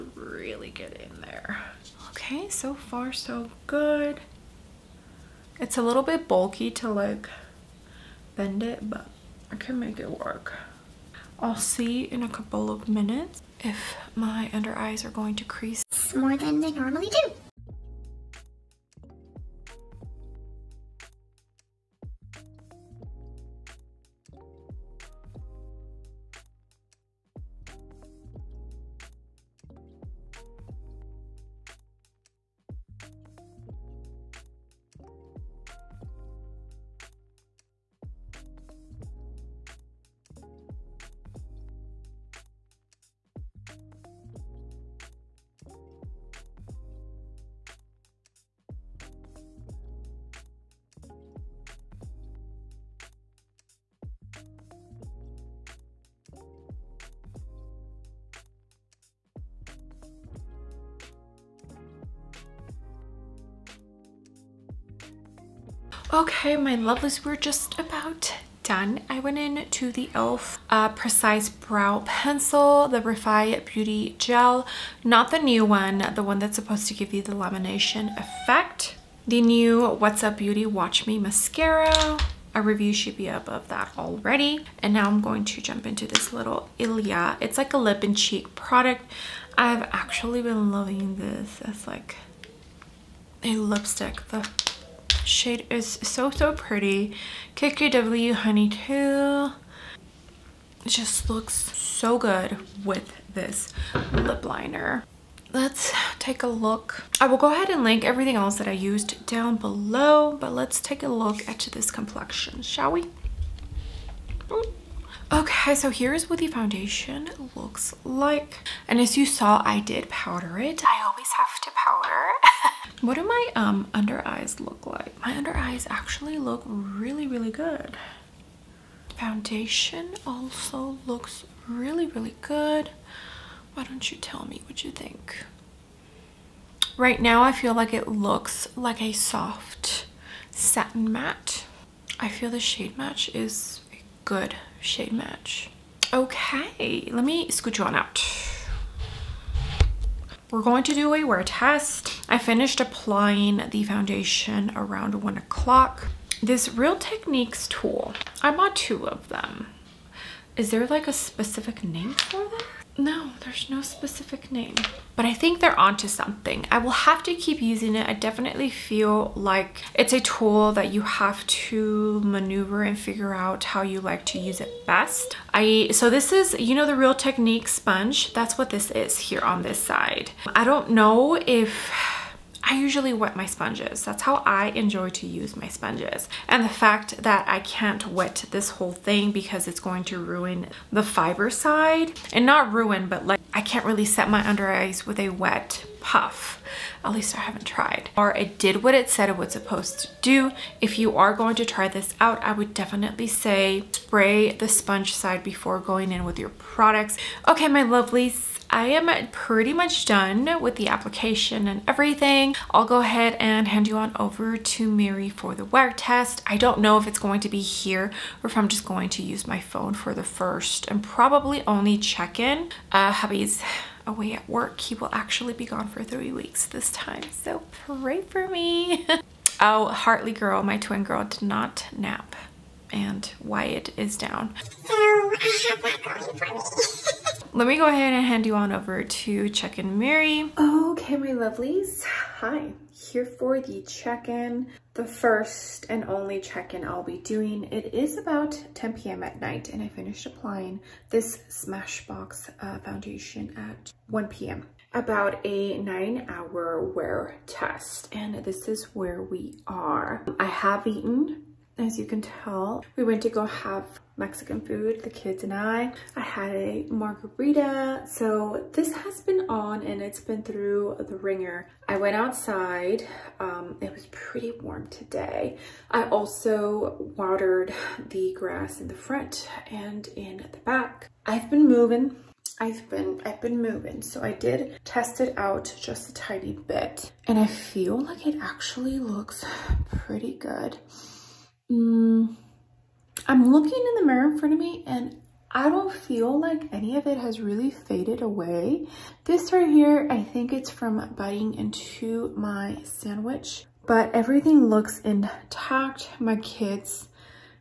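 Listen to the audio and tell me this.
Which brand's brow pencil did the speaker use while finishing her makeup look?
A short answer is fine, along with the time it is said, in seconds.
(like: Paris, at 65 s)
e.l.f., at 70 s.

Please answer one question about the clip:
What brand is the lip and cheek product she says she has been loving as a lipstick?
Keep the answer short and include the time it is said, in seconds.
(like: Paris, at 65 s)
Ilia, at 86 s.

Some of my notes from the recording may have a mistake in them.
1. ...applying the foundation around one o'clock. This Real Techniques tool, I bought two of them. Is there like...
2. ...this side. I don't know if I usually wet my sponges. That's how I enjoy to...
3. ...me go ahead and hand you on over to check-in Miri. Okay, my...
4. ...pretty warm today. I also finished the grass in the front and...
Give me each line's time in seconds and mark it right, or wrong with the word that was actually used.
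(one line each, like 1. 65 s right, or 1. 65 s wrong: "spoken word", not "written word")
1. 152 s right
2. 179 s right
3. 237 s right
4. 274 s wrong: "watered", not "finished".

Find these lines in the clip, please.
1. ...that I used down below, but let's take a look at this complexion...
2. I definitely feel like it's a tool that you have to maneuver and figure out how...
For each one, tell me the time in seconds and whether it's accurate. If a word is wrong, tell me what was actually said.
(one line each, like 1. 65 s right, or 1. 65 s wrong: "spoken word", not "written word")
1. 108 s right
2. 168 s right.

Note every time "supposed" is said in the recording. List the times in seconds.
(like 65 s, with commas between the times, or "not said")
76 s, 199 s.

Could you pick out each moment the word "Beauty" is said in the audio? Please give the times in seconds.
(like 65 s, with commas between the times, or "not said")
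73 s, 80 s.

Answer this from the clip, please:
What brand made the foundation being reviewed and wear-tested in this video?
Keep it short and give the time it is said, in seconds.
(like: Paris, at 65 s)
Smashbox, at 251 s.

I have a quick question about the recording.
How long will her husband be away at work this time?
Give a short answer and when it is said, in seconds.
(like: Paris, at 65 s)
3 weeks, at 226 s.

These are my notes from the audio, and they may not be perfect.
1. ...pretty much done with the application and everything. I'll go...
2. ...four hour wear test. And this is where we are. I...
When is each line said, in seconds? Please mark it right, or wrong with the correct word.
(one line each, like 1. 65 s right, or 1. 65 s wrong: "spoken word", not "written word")
1. 209 s right
2. 255 s wrong: "nine", not "four".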